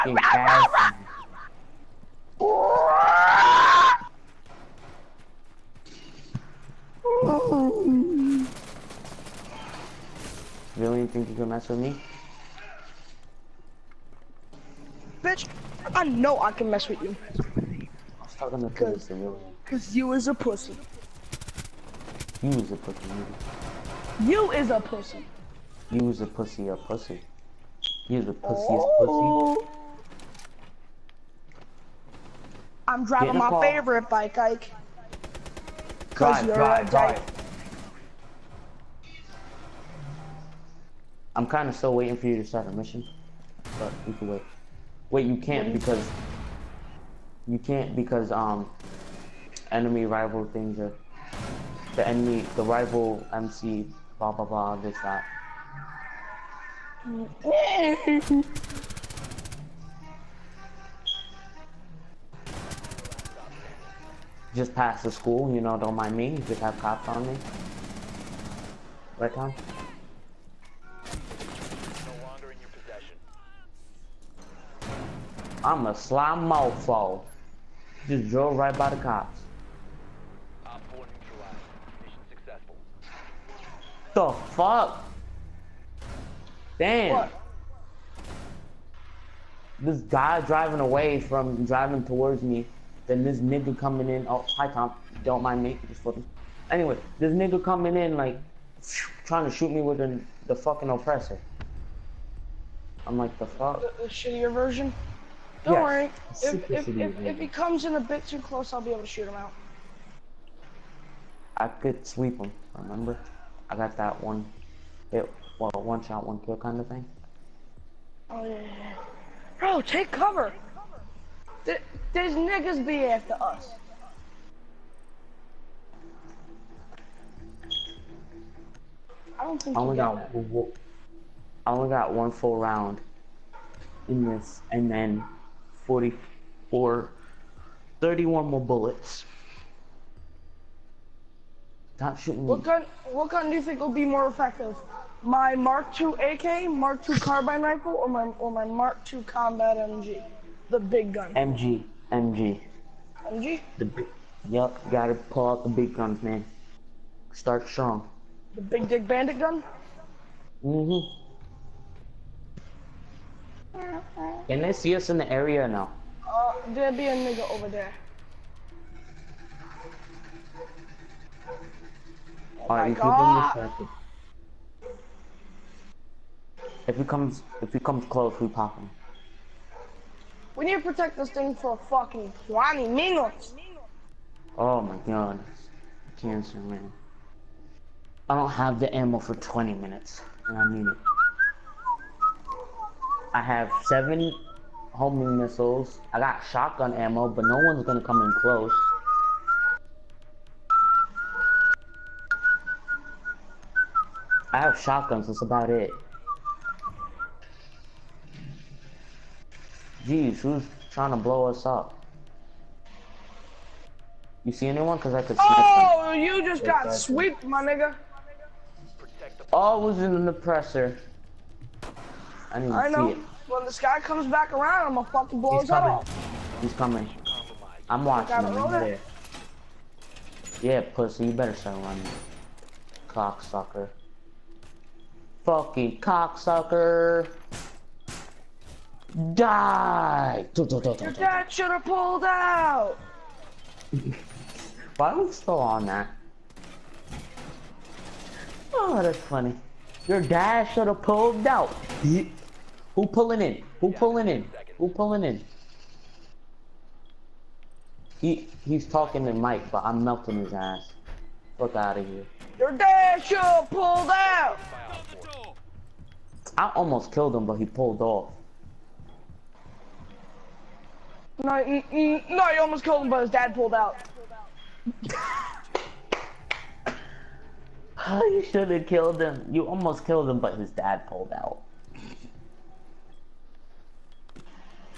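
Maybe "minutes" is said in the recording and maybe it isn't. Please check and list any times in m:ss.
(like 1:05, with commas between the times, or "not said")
3:02, 3:09.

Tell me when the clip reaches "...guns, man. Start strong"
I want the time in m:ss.
2:35.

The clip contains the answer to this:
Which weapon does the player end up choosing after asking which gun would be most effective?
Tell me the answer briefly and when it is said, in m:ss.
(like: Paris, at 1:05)
Mark II combat MG, at 2:28.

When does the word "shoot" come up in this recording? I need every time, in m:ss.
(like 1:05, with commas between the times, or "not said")
1:39, 1:49.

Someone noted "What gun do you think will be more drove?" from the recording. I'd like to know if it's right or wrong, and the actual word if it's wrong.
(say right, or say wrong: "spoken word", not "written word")
wrong: "effective", not "drove".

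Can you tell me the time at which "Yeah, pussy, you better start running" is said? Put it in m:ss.
3:50.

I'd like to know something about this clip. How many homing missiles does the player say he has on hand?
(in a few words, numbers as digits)
70.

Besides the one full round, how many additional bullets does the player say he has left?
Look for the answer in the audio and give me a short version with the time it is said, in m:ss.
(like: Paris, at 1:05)
31, at 2:18.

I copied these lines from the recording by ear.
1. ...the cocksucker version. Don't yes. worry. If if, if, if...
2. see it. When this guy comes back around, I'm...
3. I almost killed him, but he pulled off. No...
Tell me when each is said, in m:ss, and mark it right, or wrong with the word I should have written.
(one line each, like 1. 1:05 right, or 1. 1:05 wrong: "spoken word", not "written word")
1. 1:44 wrong: "shittier", not "cocksucker"
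2. 3:43 right
3. 4:26 right.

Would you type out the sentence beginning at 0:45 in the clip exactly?
Wait, you can't because you can't because um enemy rival things are the enemy the rival MC blah blah blah this that.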